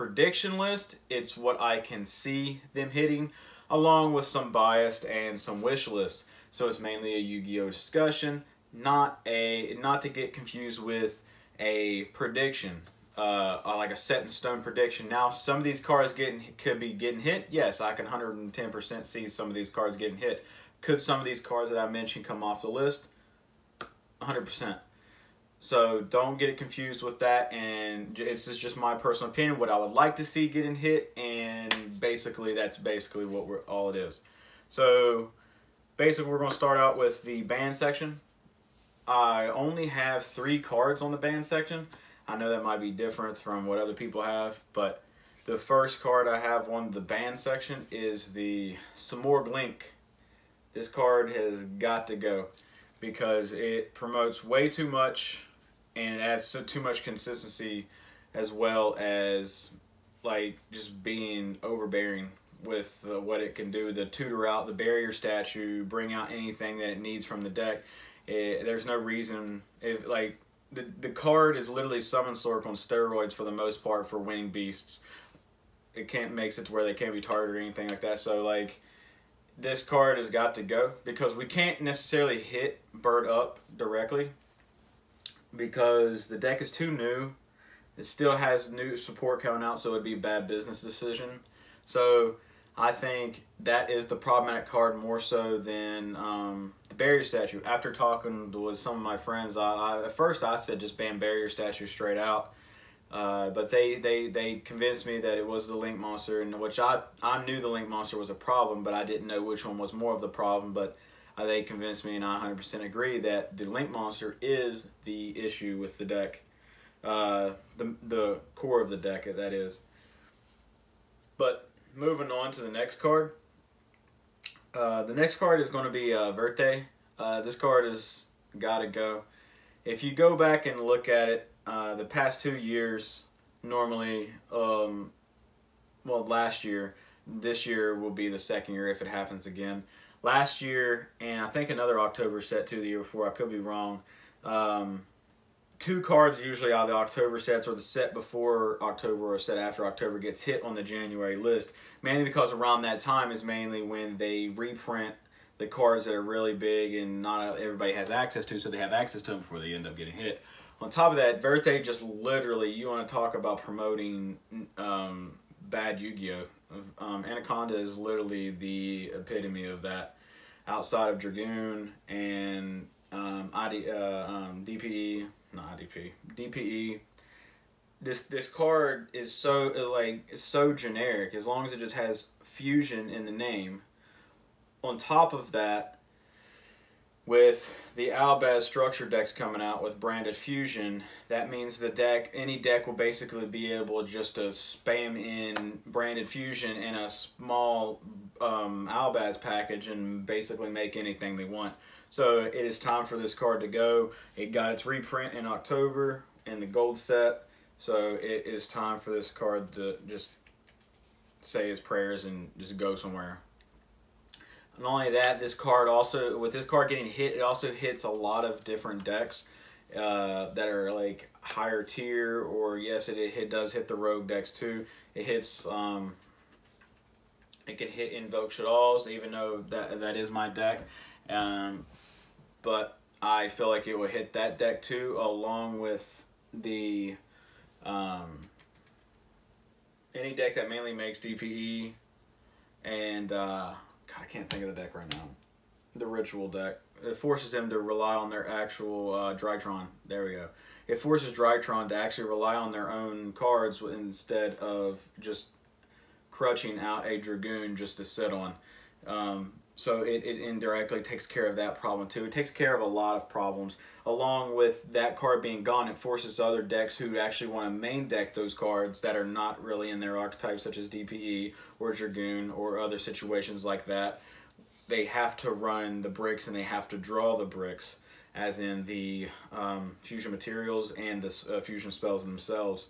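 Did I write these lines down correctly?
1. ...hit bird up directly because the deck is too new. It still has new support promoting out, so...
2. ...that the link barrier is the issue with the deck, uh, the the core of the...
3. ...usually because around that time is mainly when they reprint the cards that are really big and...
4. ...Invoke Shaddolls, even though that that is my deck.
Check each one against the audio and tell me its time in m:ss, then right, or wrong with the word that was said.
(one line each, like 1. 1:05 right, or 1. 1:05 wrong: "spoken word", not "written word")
1. 1:22 wrong: "coming", not "promoting"
2. 1:53 wrong: "monster", not "barrier"
3. 2:32 wrong: "mainly", not "usually"
4. 3:48 right.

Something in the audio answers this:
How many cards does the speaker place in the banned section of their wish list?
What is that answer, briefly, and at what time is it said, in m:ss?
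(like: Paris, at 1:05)
3, at 0:40.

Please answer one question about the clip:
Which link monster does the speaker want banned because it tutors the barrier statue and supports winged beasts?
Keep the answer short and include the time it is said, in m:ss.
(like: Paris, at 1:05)
Simorgh Link, at 0:48.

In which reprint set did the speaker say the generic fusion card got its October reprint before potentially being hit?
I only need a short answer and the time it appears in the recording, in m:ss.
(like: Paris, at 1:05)
gold set, at 3:26.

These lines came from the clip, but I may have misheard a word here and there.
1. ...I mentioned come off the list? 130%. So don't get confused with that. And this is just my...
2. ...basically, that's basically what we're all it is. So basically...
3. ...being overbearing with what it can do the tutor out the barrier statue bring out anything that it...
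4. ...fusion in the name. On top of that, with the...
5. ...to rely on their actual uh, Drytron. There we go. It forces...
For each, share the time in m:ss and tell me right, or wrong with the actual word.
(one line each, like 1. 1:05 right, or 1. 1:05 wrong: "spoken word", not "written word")
1. 0:21 wrong: "100", not "130"
2. 0:32 right
3. 1:01 right
4. 3:02 right
5. 4:07 right.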